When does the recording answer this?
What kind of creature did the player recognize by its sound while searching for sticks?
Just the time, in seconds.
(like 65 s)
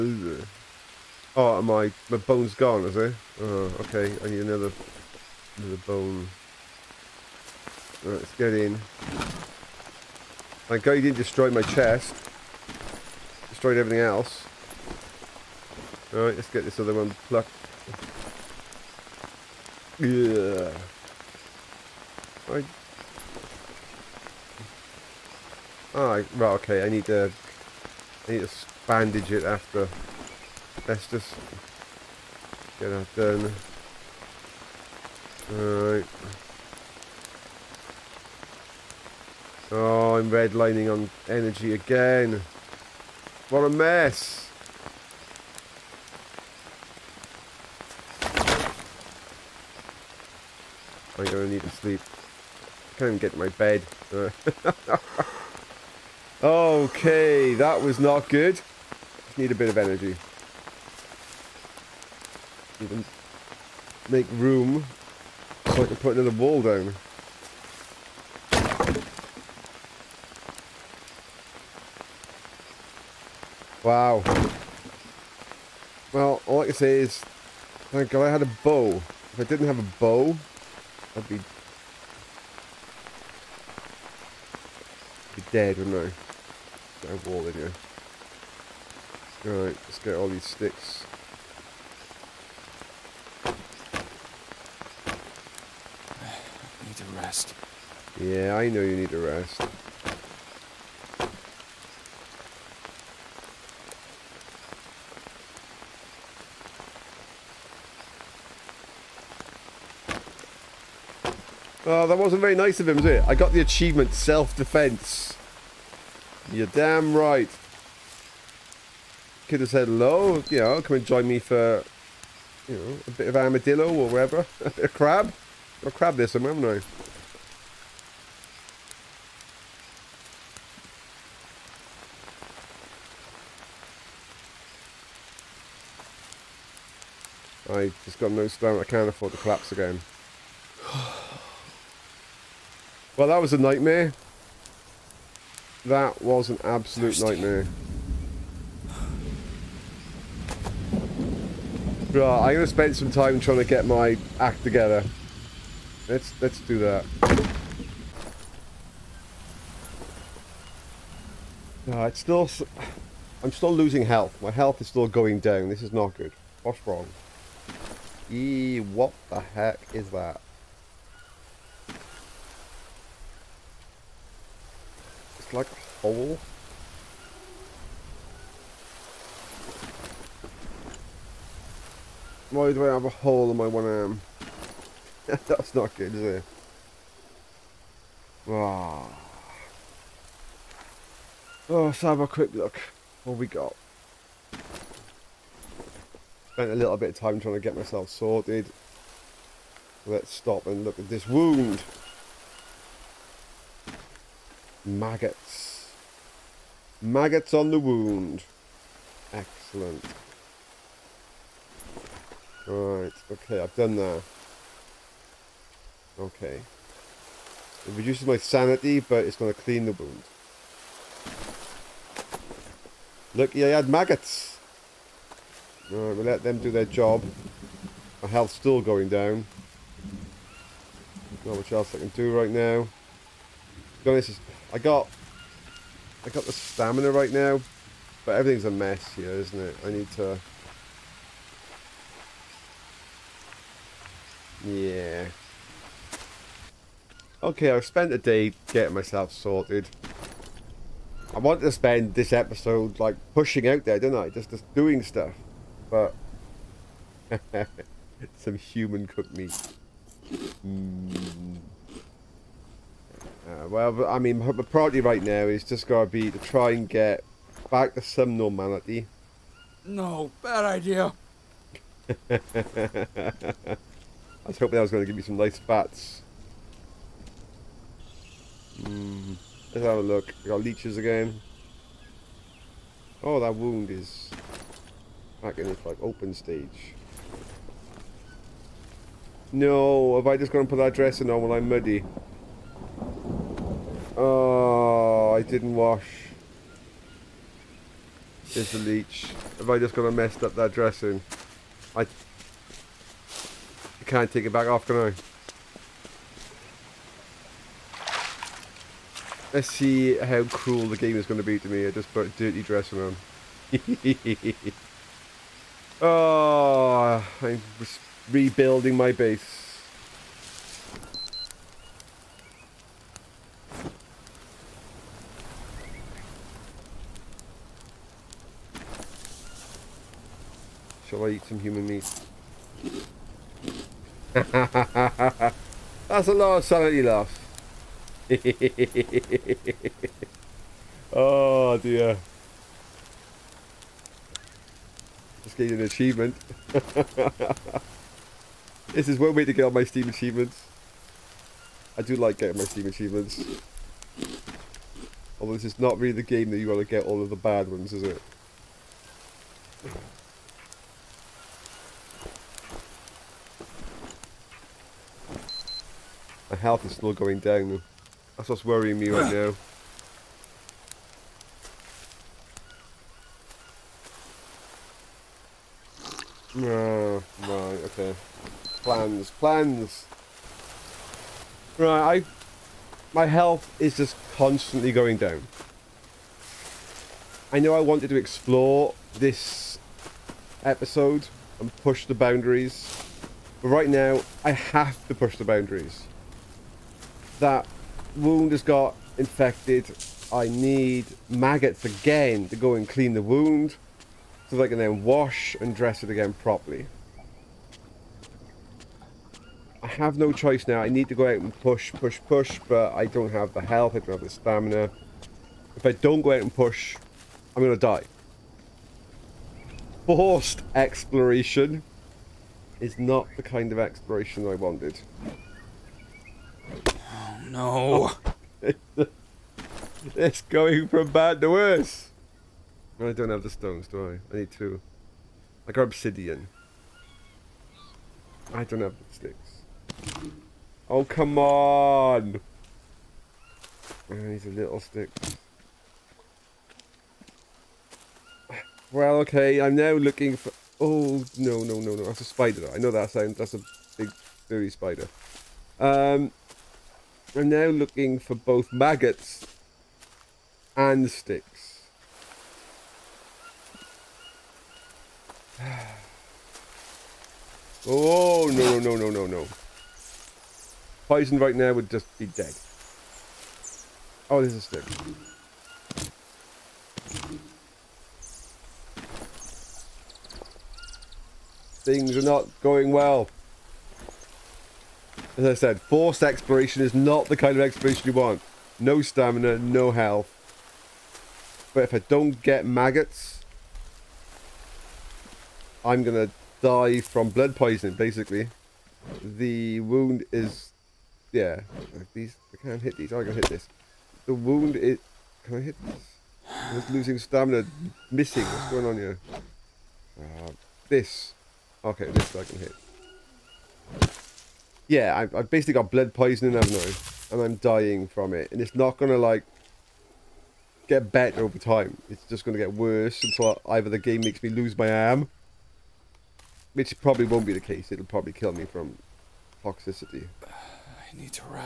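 453 s.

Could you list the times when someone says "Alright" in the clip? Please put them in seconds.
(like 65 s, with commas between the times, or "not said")
35 s, 89 s, 225 s.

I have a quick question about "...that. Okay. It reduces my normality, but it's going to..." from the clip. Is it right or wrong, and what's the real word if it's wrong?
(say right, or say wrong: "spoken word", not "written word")
wrong: "sanity", not "normality".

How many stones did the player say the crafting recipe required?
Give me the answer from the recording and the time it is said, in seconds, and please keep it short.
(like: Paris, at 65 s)
2, at 434 s.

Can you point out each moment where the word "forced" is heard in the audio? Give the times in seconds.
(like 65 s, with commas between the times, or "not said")
420 s, 485 s.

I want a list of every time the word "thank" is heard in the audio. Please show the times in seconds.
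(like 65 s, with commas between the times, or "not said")
77 s.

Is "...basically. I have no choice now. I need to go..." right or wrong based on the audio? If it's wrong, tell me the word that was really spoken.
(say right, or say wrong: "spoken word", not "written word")
wrong: "properly", not "basically".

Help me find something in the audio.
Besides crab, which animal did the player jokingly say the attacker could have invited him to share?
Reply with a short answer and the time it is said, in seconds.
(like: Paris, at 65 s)
Armadillo, at 123 s.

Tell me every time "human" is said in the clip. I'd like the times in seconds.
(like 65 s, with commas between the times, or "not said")
258 s, 331 s.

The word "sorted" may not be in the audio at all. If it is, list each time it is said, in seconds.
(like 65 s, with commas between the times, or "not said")
198 s, 249 s.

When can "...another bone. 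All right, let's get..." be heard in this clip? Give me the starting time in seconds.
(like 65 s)
5 s.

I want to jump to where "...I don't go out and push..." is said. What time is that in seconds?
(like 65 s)
415 s.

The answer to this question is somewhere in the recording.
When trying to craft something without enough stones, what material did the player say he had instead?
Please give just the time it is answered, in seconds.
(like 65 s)
435 s.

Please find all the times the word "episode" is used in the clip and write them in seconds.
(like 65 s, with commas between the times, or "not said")
252 s, 390 s.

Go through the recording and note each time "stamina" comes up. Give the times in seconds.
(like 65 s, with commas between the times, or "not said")
138 s, 236 s, 414 s, 489 s, 507 s.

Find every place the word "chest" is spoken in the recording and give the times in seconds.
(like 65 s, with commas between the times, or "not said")
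11 s.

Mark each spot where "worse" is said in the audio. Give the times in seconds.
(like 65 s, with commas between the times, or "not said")
431 s, 522 s.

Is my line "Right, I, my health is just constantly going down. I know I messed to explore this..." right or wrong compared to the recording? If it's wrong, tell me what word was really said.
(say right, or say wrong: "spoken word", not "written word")
wrong: "wanted", not "messed".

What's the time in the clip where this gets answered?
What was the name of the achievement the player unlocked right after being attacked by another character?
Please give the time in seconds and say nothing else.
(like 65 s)
114 s.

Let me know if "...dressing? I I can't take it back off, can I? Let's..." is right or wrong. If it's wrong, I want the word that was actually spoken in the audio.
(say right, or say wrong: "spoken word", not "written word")
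right.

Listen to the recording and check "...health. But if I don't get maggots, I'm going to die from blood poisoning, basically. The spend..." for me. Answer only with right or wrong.
wrong.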